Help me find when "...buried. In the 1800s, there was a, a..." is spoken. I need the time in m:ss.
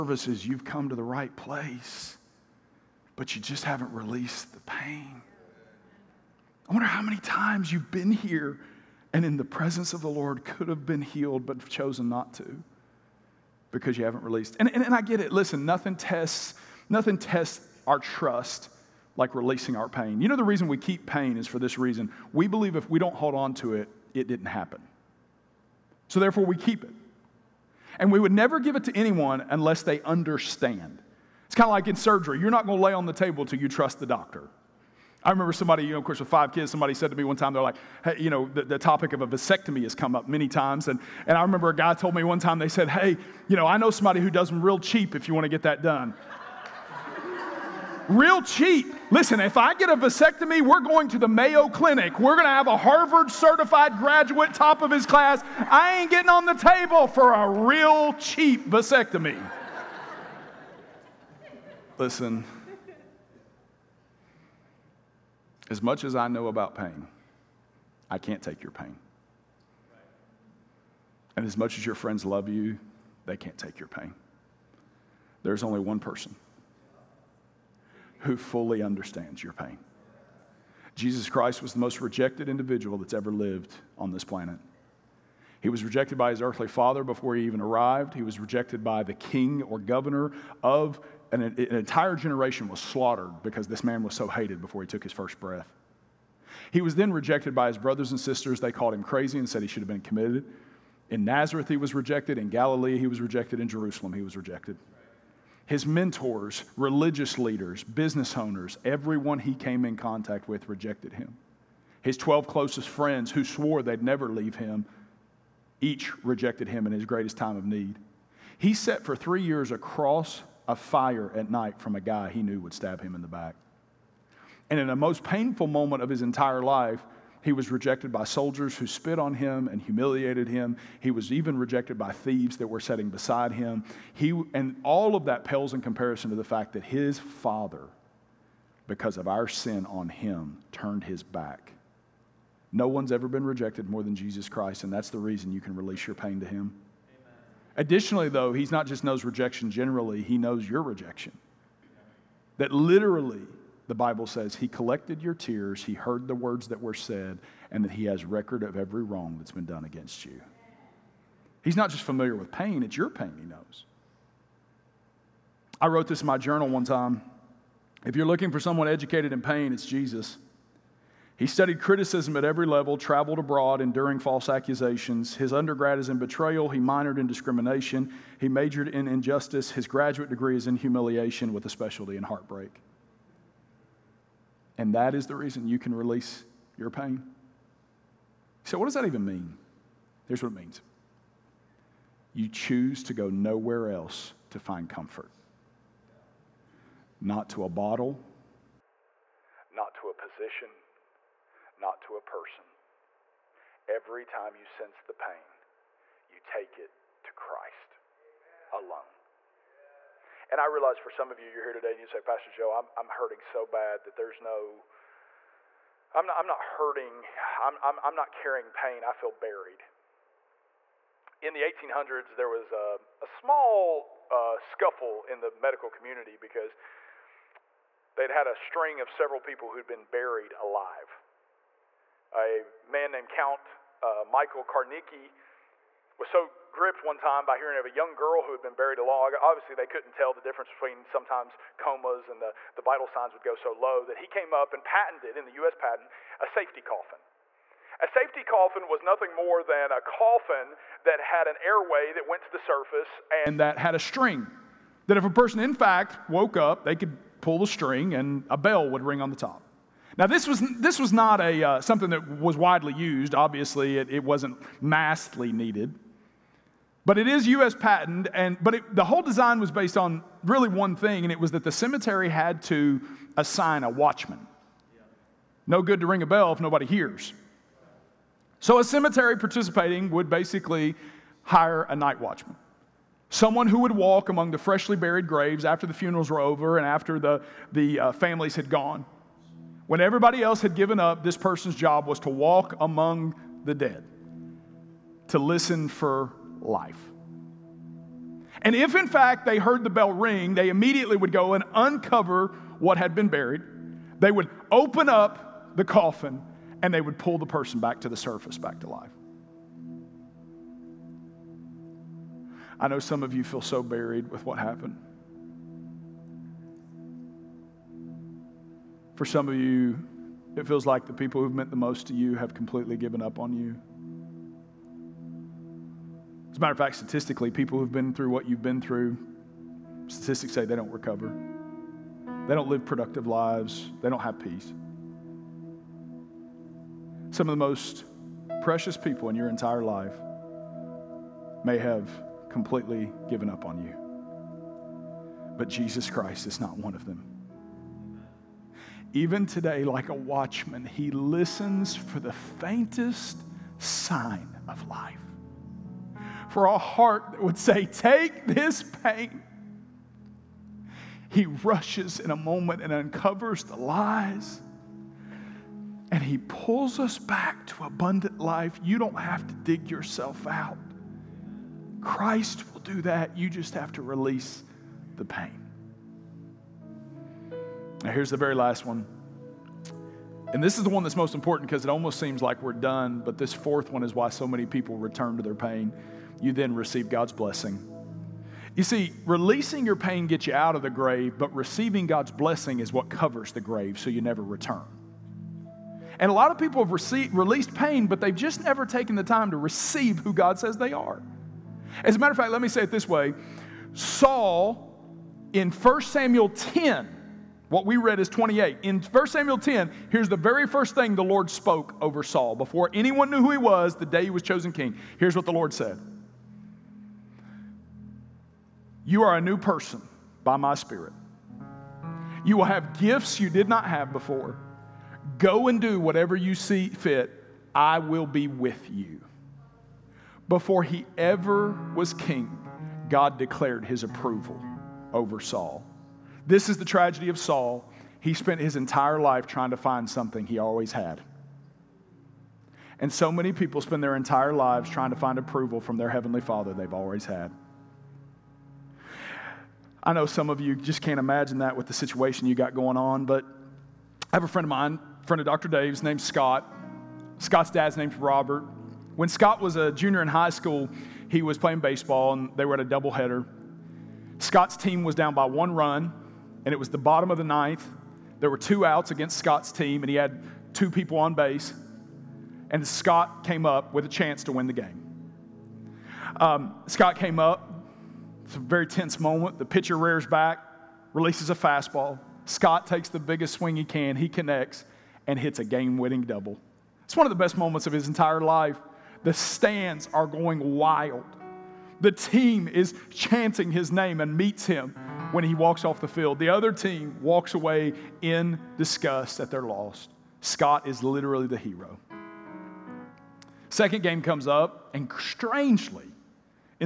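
3:39.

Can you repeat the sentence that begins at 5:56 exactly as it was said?
For a heart that would say, Take this pain.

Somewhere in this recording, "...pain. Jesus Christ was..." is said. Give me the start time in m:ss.
1:19.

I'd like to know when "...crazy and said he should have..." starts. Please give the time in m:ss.
1:39.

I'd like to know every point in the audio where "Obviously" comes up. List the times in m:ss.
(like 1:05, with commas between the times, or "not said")
3:59, 4:23.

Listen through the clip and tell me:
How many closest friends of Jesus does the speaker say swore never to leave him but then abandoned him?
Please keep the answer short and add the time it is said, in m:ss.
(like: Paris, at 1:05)
12, at 1:52.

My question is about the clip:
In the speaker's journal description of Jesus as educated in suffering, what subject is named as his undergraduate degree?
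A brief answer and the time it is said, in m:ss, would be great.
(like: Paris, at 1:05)
Betrayal, at 2:56.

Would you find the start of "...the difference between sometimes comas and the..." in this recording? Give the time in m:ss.
4:00.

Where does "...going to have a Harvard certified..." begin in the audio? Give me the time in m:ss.
0:52.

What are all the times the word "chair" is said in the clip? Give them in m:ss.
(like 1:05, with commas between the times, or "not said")
not said.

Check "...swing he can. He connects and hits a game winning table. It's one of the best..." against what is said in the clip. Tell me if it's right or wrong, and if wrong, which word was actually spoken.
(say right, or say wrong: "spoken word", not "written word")
wrong: "double", not "table".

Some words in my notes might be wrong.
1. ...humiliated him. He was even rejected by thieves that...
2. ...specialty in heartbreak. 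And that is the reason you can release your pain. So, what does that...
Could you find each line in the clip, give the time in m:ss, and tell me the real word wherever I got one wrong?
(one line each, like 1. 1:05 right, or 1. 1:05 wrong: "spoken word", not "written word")
1. 2:09 right
2. 3:01 right.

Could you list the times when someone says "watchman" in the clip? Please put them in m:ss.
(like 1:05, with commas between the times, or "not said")
4:33, 4:42, 5:50.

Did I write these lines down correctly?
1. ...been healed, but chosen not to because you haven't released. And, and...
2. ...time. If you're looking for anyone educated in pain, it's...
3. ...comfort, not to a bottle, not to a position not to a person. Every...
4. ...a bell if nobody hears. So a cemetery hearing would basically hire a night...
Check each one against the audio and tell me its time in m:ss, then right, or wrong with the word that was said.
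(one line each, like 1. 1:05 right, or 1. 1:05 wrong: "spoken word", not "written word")
1. 0:10 right
2. 2:46 wrong: "someone", not "anyone"
3. 3:14 right
4. 4:36 wrong: "participating", not "hearing".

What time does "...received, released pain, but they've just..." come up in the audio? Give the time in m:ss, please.
6:36.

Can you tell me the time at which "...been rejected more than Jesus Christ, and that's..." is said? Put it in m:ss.
2:23.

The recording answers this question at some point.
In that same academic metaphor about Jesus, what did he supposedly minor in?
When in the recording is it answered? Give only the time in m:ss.
2:57.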